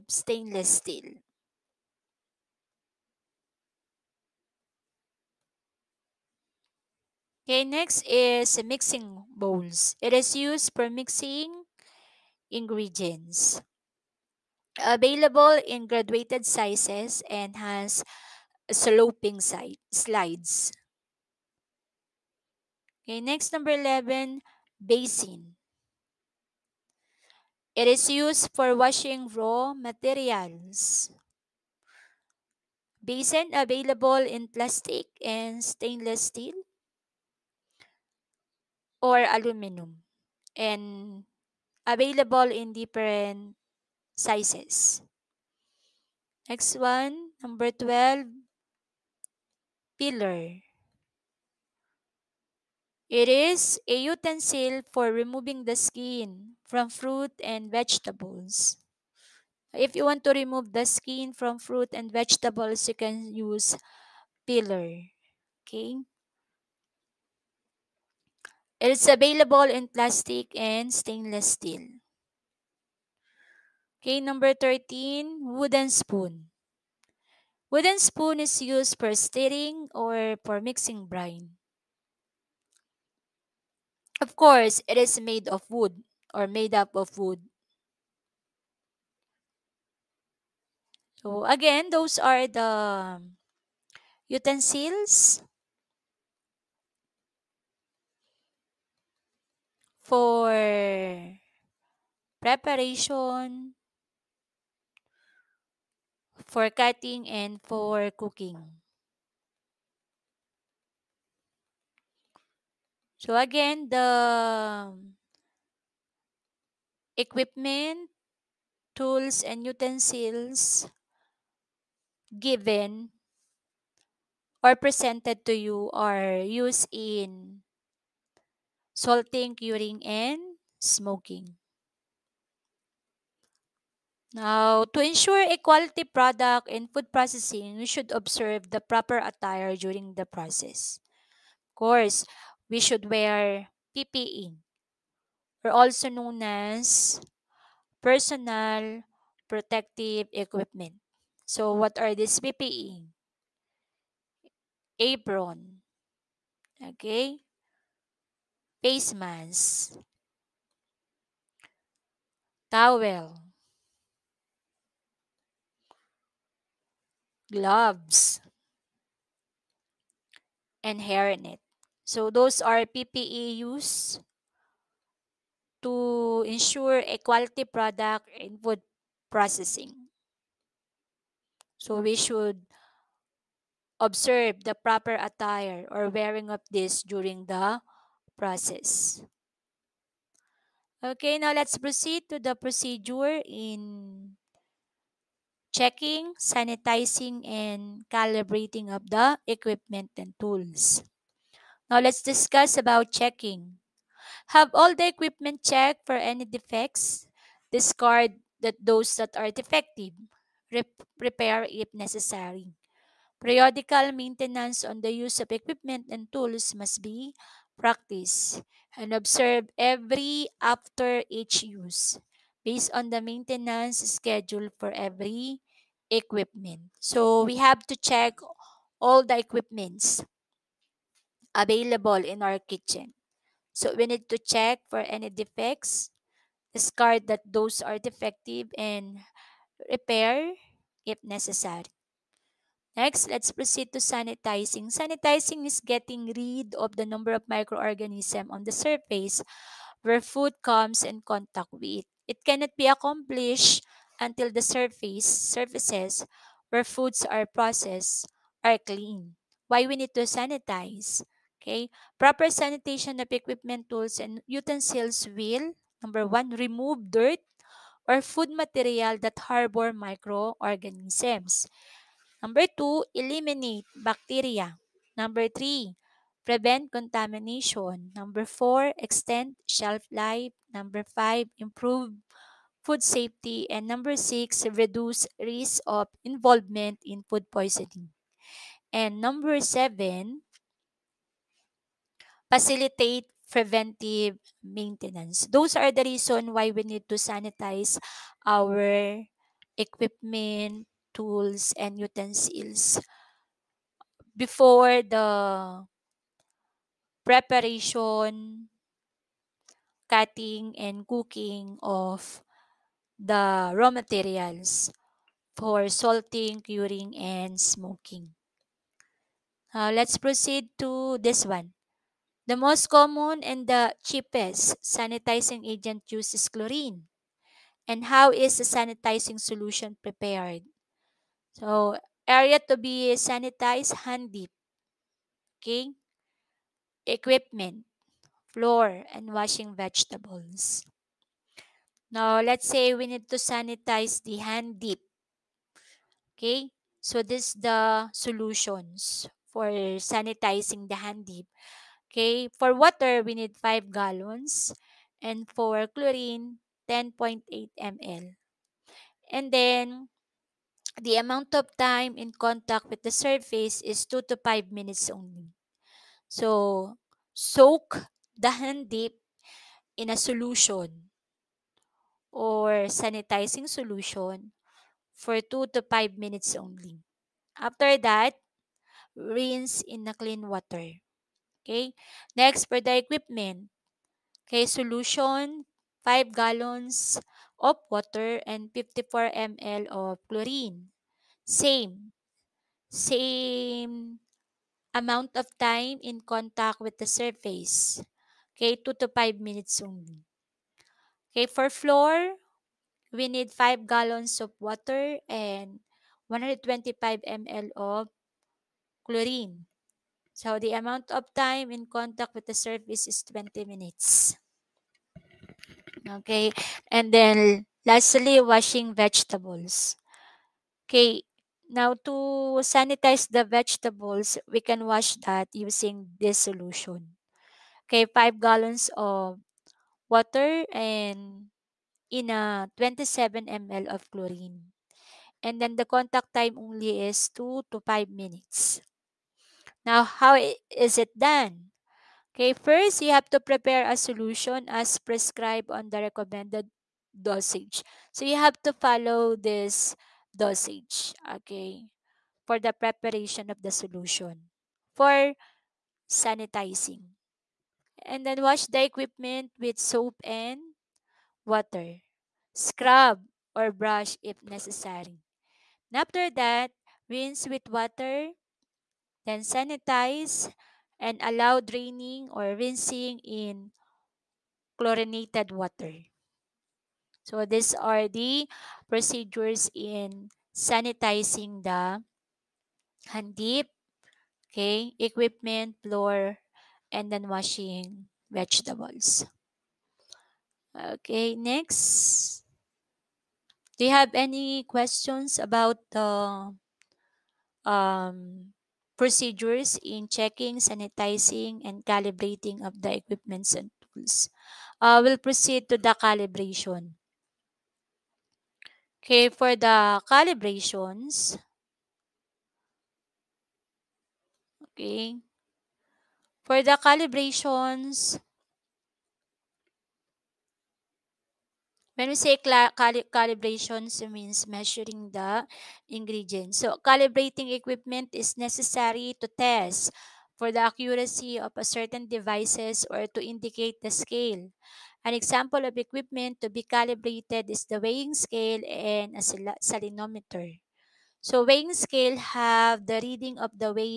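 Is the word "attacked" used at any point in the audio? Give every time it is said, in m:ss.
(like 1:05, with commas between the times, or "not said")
not said.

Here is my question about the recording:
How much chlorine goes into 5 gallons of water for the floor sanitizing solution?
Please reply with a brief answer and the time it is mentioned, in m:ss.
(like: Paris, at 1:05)
125 ml, at 6:46.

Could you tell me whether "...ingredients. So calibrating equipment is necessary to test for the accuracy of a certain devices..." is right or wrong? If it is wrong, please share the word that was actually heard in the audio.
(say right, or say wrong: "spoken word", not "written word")
right.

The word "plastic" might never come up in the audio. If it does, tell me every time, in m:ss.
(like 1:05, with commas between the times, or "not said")
0:34, 1:09.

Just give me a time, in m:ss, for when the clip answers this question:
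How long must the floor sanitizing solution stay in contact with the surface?
6:53.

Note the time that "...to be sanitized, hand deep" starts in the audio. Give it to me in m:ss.
5:32.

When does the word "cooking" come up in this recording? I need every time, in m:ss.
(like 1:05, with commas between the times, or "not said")
1:48, 5:11.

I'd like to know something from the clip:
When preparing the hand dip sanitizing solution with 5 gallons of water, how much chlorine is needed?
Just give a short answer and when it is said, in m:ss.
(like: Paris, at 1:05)
10.8 ml, at 5:56.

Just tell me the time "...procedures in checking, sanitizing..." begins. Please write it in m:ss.
8:18.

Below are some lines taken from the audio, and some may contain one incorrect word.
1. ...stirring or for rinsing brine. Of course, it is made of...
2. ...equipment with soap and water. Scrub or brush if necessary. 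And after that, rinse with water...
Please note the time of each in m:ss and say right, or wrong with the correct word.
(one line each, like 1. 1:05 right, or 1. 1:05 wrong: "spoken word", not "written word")
1. 1:19 wrong: "mixing", not "rinsing"
2. 7:38 right.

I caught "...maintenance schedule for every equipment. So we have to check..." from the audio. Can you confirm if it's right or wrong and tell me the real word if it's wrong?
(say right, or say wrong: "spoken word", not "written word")
right.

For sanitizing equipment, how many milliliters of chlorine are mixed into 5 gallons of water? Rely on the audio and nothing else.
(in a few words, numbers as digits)
54 ml.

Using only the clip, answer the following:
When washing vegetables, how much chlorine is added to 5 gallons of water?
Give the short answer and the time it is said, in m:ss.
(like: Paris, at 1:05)
27 ml, at 7:12.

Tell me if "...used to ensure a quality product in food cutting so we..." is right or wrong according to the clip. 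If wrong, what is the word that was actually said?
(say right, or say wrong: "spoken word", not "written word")
wrong: "processing", not "cutting".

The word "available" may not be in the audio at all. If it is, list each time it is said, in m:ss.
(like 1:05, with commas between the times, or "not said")
0:14, 0:33, 0:41, 1:09, 3:51.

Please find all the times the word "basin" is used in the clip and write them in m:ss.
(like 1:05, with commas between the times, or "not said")
0:24, 0:33.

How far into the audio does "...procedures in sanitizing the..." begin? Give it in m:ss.
7:58.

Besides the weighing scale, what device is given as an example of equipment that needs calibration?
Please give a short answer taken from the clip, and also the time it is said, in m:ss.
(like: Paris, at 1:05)
Salinometer, at 8:59.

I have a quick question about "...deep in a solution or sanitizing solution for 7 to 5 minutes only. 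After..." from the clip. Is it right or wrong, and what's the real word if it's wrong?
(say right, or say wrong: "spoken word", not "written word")
wrong: "2", not "7".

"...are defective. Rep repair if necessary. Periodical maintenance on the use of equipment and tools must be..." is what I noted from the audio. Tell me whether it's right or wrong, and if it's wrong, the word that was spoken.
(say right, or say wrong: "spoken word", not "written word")
right.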